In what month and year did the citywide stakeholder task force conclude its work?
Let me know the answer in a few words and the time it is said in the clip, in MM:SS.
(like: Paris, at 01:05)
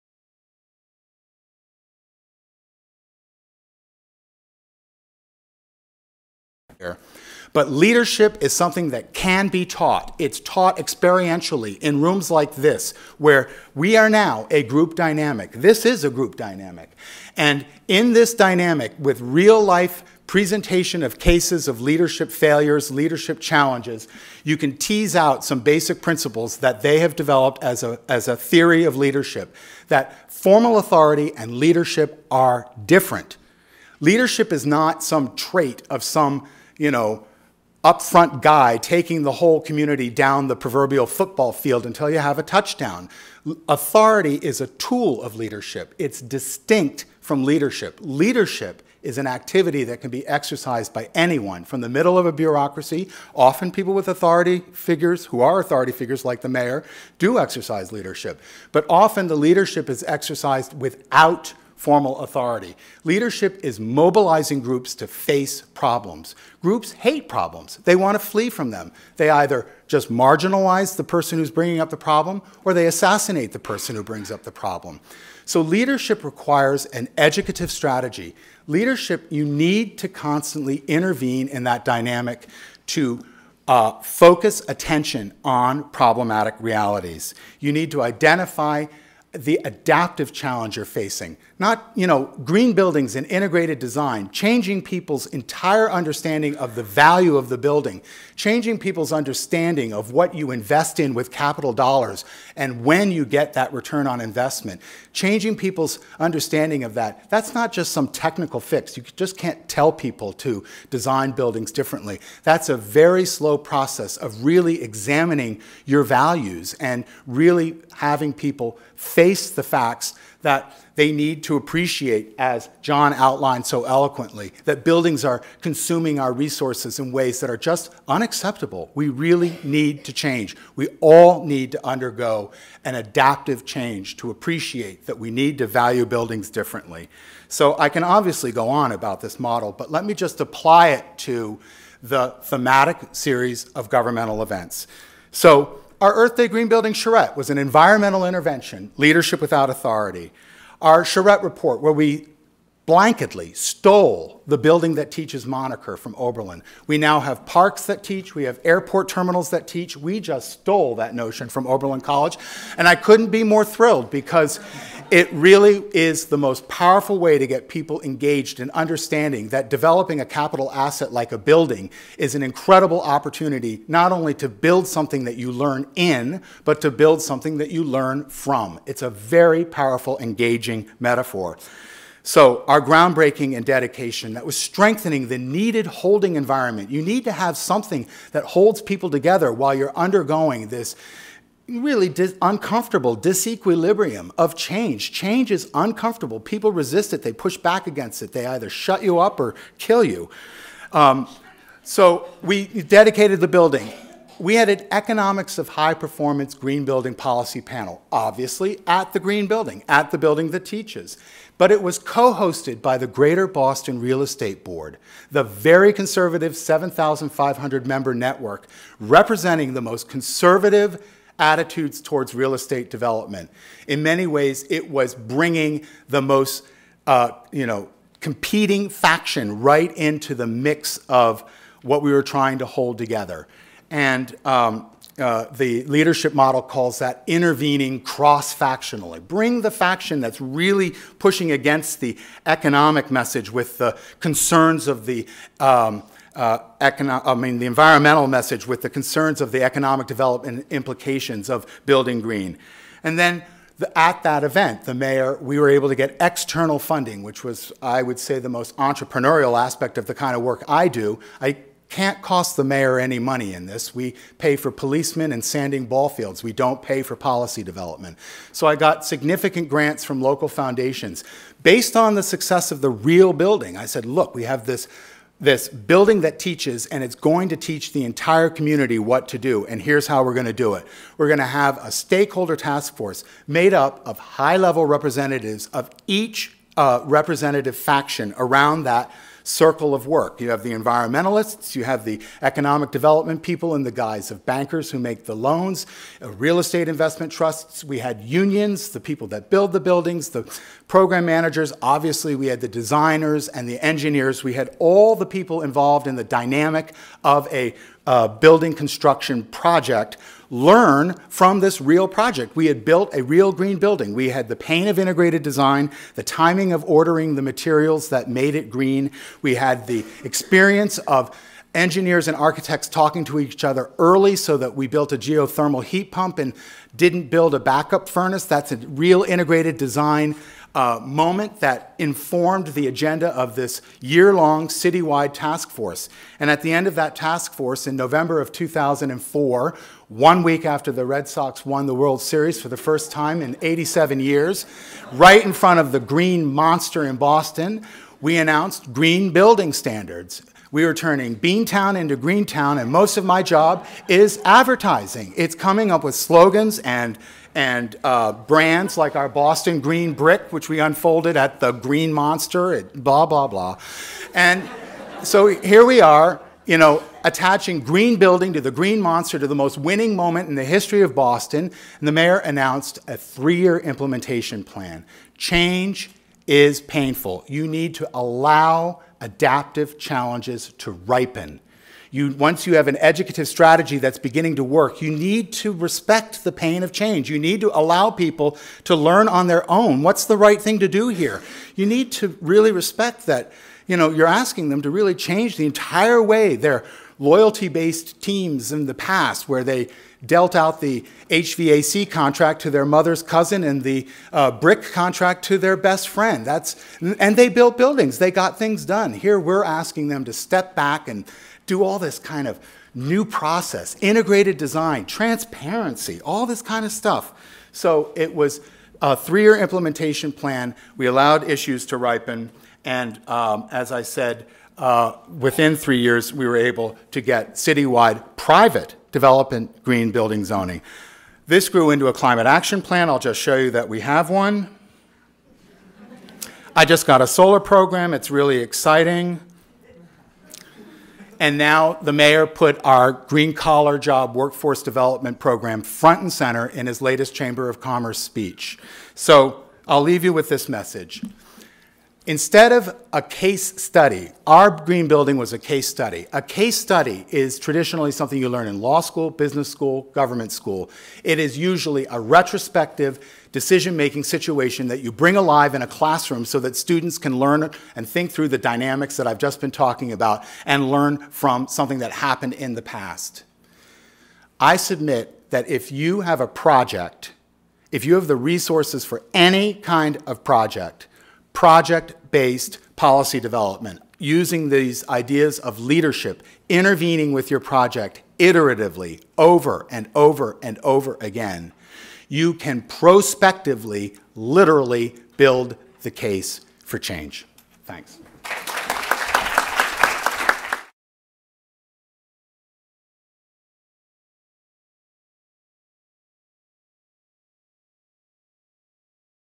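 November 2004, at 05:37.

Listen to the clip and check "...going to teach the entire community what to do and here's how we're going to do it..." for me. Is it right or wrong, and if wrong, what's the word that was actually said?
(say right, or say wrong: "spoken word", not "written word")
right.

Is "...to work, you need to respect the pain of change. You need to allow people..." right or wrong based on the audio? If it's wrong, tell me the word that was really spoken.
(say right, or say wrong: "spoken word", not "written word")
right.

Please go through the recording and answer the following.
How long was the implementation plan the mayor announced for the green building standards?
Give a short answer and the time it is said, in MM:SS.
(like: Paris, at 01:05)
3 years, at 06:13.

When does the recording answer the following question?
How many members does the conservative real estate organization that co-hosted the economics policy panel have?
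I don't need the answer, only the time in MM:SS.
03:36.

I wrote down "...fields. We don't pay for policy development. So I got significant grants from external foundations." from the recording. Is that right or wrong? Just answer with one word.
wrong.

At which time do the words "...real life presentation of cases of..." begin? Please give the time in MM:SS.
00:19.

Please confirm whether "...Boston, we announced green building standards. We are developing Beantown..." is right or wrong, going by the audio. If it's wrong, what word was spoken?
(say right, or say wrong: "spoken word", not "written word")
wrong: "turning", not "developing".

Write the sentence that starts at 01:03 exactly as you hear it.
Leadership is mobilizing groups to face problems.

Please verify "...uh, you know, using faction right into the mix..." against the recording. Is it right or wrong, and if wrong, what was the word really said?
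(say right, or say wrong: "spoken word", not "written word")
wrong: "competing", not "using".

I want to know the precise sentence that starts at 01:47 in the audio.
That's not just some technical fix.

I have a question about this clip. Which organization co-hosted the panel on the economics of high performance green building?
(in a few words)
Greater Boston Real Estate Board.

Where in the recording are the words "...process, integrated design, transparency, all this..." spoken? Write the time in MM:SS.
06:53.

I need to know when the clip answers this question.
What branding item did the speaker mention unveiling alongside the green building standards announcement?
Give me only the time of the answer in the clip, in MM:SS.
05:59.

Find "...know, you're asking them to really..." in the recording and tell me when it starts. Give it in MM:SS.
06:33.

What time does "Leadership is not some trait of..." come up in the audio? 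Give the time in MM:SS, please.
00:33.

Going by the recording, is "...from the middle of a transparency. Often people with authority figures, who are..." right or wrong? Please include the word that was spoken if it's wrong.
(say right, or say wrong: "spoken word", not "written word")
wrong: "bureaucracy", not "transparency".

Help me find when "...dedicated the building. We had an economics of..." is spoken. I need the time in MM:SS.
03:22.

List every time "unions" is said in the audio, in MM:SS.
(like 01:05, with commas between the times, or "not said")
04:58.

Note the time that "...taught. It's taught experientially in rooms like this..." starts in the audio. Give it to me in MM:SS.
00:09.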